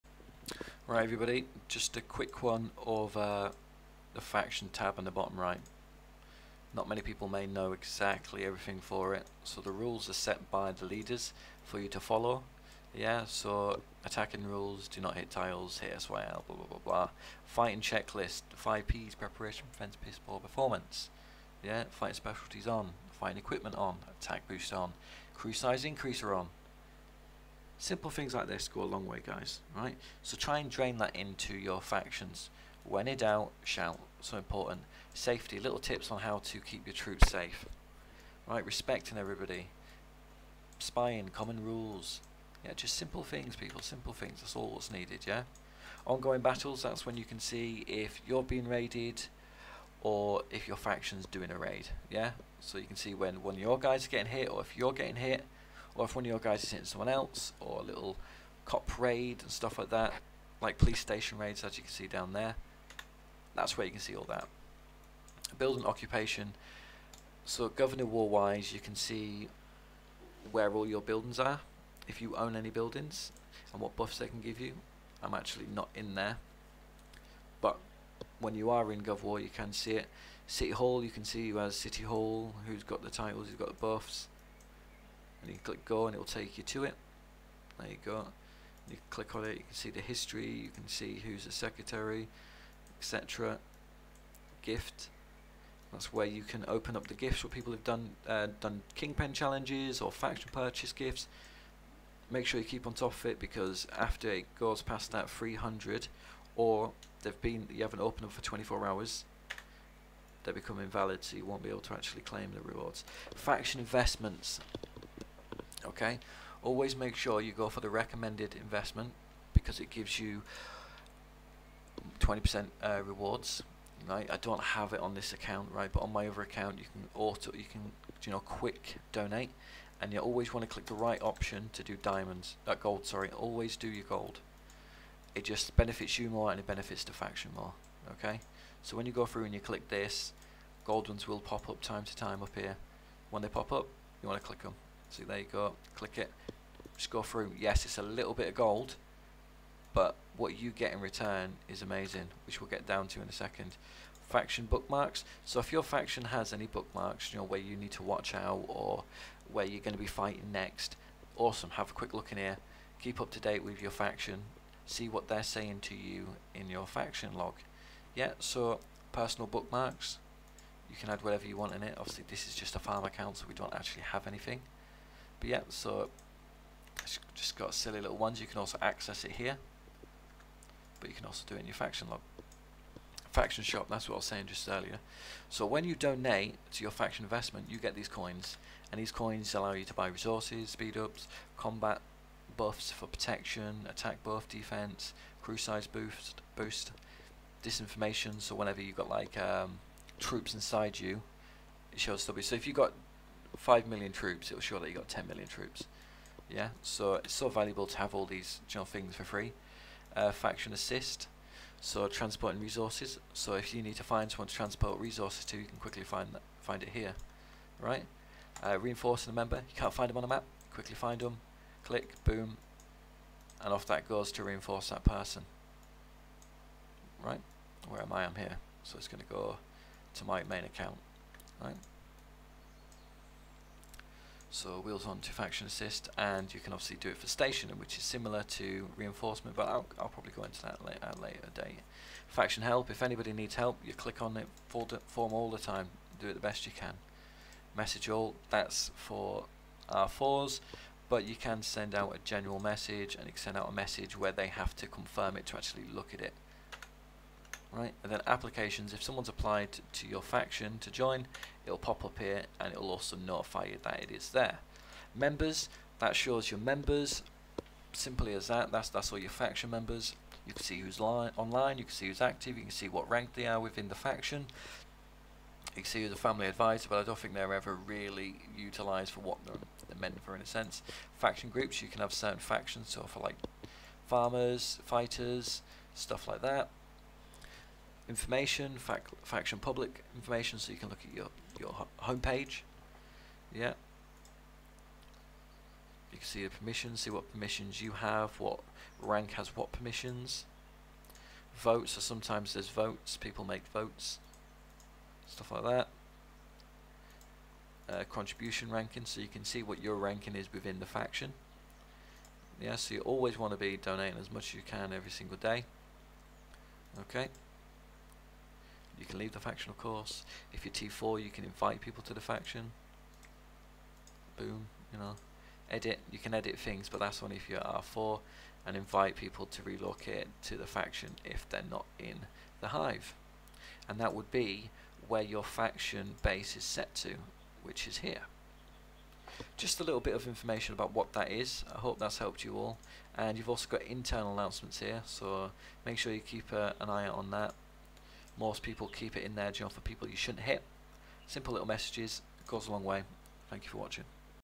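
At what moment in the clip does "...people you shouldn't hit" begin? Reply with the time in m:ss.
5:49.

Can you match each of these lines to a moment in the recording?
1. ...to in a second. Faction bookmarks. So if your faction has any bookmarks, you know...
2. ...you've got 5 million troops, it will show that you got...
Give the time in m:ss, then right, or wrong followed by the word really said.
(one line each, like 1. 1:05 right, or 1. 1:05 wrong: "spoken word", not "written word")
1. 2:33 right
2. 3:22 right.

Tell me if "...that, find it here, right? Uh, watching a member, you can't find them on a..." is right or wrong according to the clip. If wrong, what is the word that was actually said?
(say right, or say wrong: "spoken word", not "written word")
wrong: "reinforcing", not "watching".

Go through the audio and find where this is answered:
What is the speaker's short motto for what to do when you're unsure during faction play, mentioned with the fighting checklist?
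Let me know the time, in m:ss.
0:32.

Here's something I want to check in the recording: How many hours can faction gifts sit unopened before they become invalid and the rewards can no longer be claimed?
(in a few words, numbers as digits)
24.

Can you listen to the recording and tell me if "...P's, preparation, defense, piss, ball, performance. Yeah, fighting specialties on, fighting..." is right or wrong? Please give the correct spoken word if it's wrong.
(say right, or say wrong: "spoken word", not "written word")
right.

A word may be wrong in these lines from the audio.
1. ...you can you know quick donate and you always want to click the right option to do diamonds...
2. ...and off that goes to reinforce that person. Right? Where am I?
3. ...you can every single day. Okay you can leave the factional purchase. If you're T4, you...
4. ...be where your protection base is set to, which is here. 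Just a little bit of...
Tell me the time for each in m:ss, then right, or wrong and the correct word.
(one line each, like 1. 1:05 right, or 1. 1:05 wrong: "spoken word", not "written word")
1. 2:07 right
2. 3:43 right
3. 5:14 wrong: "course", not "purchase"
4. 5:34 wrong: "faction", not "protection".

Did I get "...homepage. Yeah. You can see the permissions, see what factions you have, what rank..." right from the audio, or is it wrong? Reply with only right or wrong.
wrong.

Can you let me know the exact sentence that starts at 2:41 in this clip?
Have a quick look in here.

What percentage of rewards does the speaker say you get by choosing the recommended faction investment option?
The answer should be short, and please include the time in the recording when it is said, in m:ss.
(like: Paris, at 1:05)
20%, at 2:02.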